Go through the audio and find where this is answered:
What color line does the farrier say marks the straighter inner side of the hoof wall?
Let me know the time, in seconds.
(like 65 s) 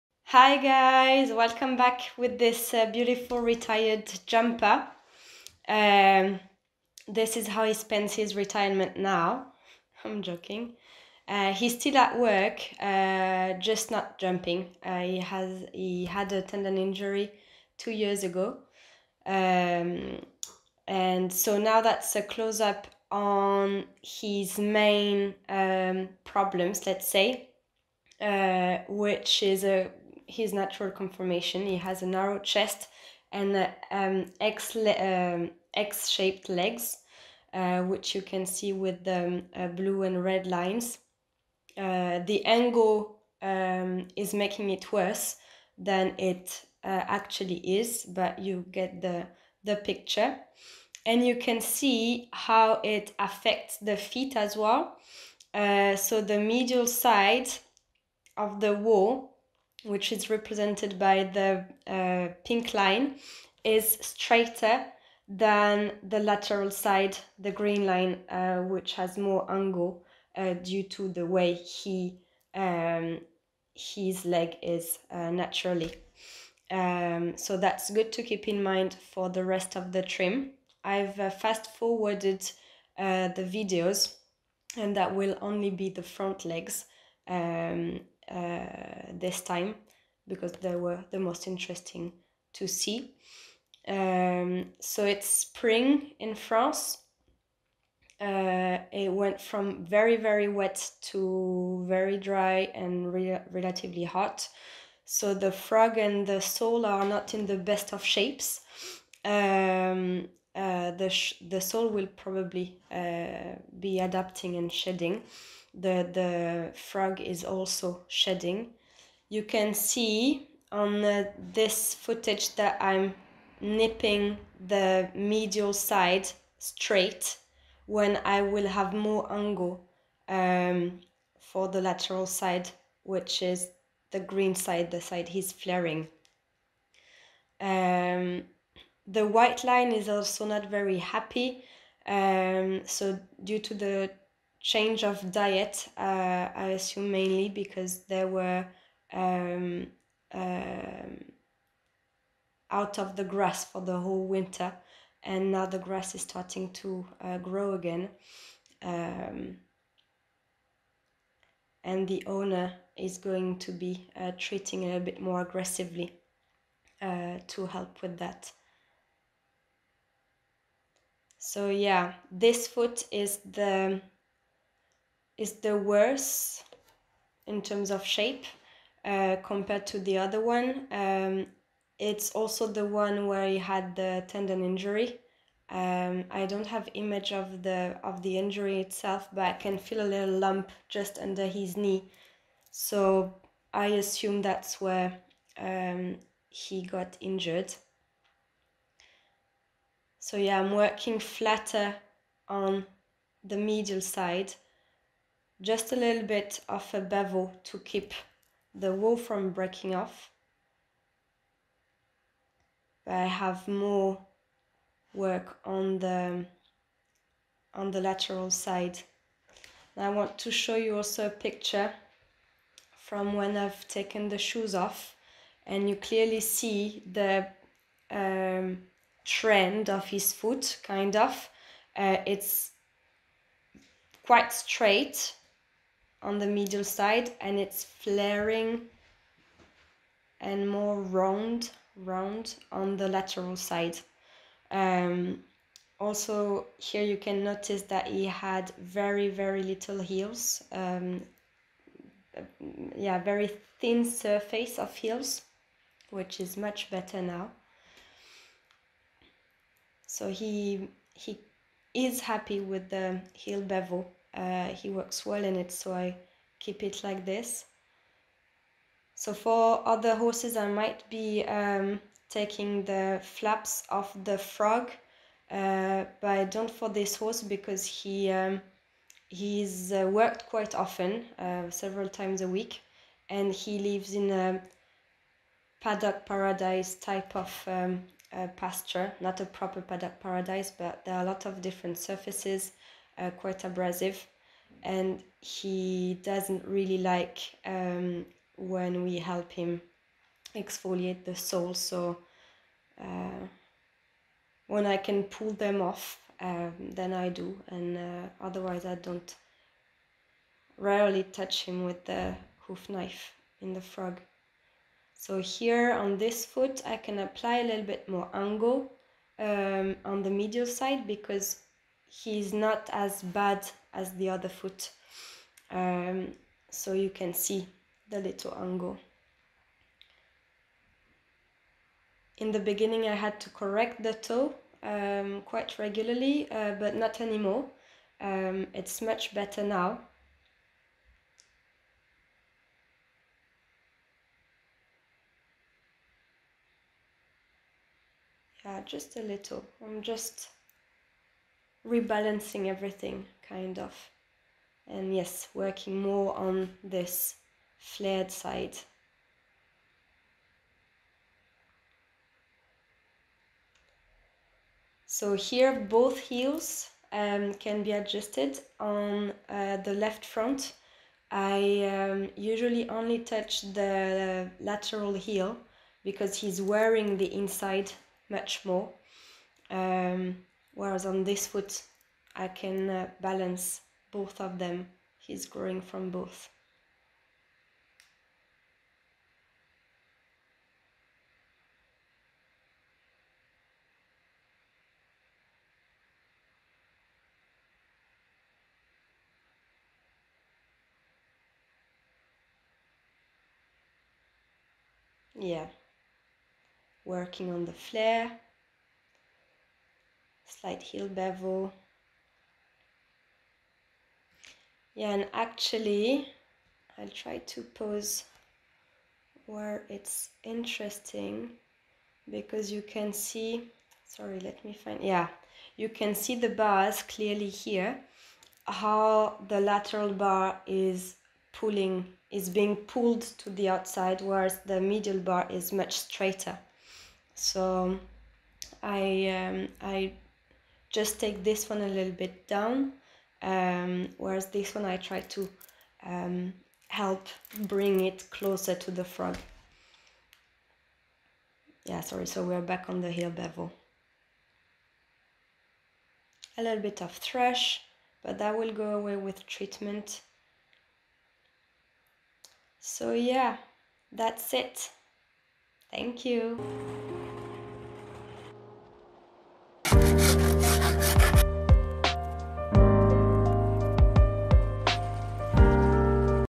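62 s.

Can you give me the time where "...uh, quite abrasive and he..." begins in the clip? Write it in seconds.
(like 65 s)
293 s.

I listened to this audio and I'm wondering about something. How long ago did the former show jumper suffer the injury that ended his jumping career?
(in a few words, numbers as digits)
2 years.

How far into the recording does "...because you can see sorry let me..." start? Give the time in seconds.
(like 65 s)
422 s.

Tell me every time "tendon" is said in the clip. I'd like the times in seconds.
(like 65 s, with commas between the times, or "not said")
16 s, 184 s.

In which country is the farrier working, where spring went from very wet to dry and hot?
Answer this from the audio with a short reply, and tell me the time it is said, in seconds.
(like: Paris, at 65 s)
France, at 96 s.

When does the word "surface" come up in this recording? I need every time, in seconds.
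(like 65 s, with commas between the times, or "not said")
254 s, 291 s.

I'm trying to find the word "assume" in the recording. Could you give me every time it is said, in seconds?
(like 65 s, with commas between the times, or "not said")
146 s, 193 s.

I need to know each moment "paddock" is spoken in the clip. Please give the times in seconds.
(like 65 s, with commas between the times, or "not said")
285 s, 289 s.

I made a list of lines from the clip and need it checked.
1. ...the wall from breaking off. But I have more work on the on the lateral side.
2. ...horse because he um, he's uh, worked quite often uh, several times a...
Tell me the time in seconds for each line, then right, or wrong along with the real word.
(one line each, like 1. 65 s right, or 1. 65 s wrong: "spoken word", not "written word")
1. 208 s right
2. 277 s right.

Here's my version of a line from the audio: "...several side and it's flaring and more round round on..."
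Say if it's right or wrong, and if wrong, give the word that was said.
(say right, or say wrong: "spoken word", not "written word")
wrong: "medial", not "several".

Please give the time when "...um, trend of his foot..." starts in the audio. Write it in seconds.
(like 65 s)
228 s.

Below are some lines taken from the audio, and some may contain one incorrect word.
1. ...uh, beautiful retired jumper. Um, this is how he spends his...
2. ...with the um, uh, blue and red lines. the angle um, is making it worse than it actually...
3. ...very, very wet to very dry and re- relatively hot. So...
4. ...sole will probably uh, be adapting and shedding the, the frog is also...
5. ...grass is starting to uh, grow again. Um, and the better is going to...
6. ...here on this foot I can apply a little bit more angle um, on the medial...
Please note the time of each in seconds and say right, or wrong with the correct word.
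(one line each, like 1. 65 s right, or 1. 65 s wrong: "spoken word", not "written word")
1. 2 s right
2. 38 s right
3. 99 s right
4. 111 s right
5. 155 s wrong: "owner", not "better"
6. 315 s right.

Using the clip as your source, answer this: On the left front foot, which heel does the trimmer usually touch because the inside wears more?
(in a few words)
Lateral heel.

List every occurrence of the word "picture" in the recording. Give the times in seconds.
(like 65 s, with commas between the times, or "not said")
49 s, 221 s.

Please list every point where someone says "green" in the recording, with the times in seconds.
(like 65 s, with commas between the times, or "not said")
67 s, 134 s.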